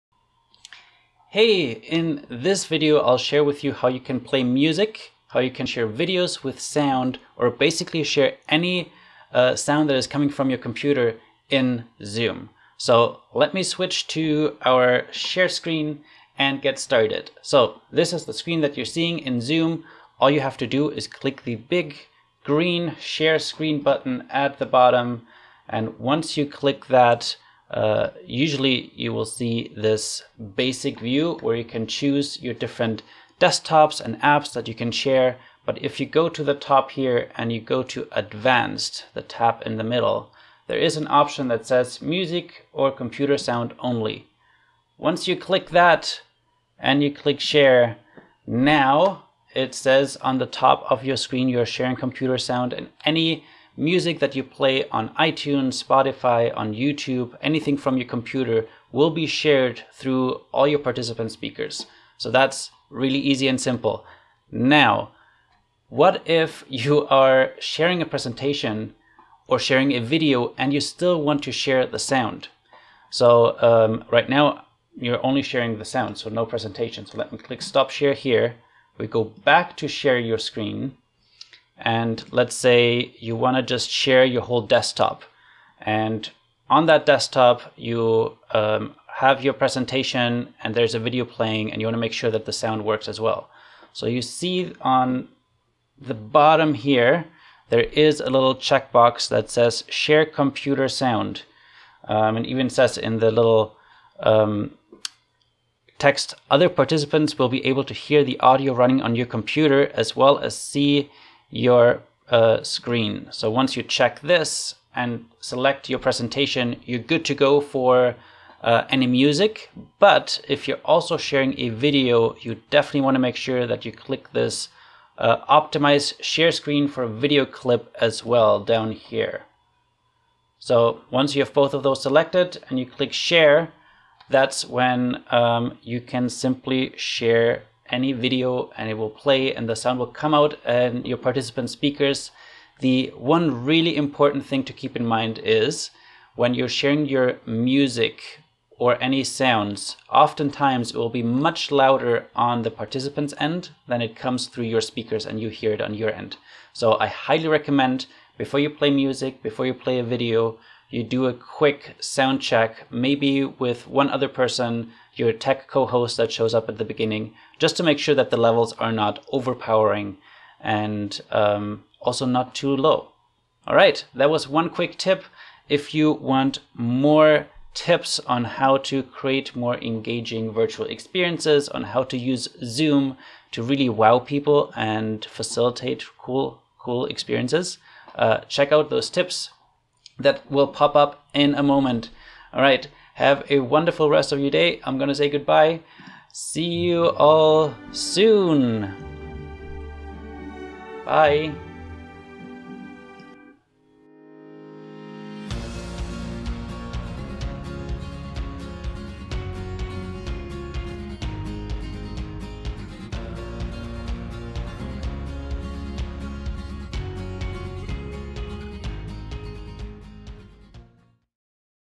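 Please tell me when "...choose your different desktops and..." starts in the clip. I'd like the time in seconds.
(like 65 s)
31 s.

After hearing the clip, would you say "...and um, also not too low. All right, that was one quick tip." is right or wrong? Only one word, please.
right.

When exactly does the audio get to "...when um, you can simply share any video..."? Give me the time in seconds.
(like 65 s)
134 s.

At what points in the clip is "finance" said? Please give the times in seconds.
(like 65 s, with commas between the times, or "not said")
not said.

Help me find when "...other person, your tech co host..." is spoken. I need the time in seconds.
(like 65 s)
164 s.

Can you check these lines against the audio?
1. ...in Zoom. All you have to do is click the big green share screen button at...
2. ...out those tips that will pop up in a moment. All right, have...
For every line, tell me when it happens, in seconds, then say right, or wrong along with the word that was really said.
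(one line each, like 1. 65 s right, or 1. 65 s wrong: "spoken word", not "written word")
1. 19 s right
2. 188 s right.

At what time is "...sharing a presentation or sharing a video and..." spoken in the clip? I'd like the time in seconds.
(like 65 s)
67 s.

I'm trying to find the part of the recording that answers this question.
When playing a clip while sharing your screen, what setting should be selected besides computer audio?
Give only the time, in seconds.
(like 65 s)
125 s.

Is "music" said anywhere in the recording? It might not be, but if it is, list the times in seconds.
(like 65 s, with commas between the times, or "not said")
4 s, 42 s, 53 s, 119 s, 147 s, 158 s.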